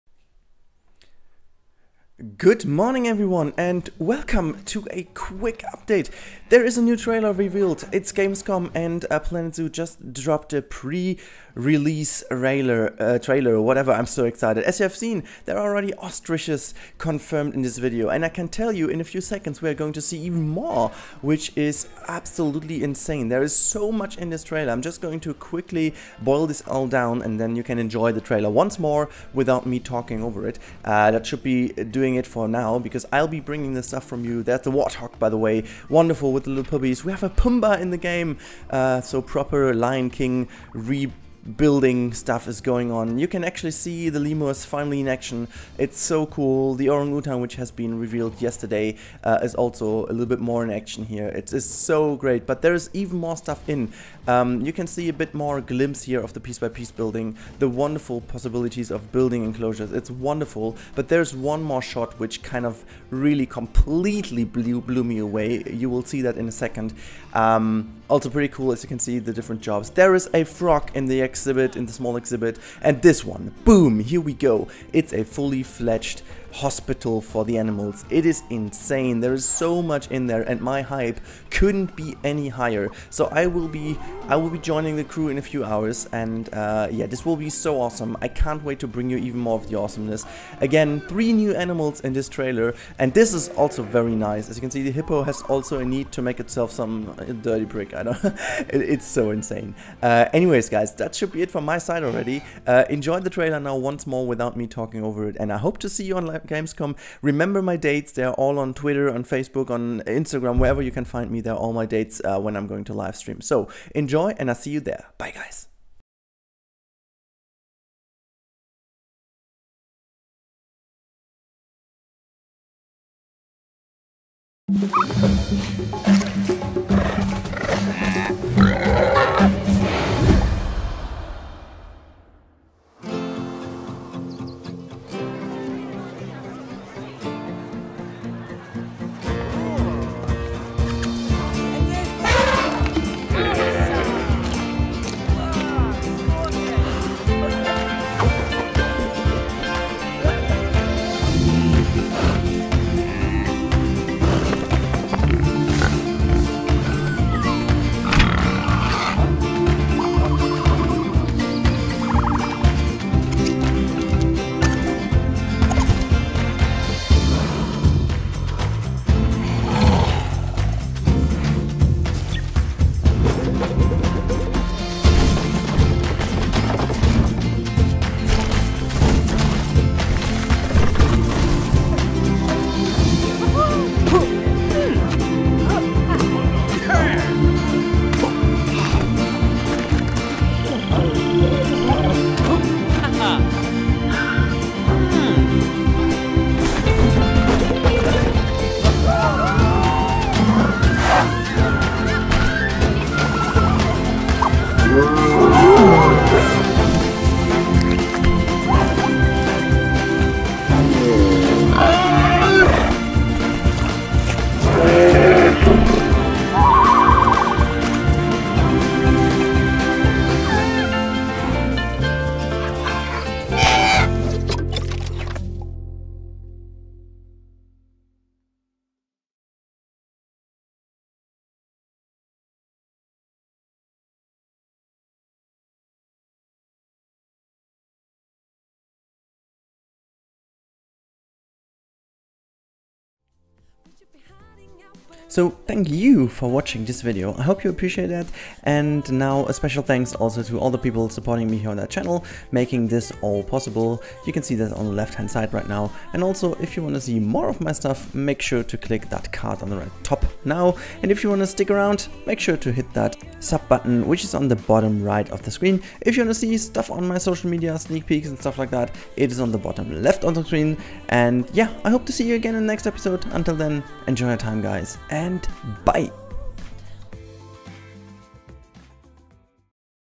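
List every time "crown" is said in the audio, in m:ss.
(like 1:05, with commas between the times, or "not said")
not said.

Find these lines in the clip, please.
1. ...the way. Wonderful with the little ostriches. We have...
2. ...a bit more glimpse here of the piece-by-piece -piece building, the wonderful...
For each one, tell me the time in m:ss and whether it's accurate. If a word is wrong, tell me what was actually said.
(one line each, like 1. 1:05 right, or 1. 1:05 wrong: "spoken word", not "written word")
1. 0:35 wrong: "puppies", not "ostriches"
2. 0:55 right.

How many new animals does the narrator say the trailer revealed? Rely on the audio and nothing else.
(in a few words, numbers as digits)
3.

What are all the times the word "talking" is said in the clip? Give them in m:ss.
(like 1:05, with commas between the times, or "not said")
0:29, 1:44.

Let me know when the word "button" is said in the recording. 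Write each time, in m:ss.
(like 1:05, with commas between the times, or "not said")
4:23.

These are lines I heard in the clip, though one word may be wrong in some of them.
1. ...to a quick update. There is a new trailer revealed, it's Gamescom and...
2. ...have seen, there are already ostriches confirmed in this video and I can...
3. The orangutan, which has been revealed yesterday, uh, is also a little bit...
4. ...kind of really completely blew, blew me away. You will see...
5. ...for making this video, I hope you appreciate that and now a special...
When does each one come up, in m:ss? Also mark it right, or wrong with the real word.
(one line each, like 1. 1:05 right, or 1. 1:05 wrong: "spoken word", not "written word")
1. 0:04 right
2. 0:14 right
3. 0:46 right
4. 1:02 right
5. 4:06 wrong: "watching", not "making".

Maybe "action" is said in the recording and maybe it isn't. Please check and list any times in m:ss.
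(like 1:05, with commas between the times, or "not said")
0:45, 0:50.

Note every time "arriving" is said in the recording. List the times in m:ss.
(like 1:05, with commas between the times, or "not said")
not said.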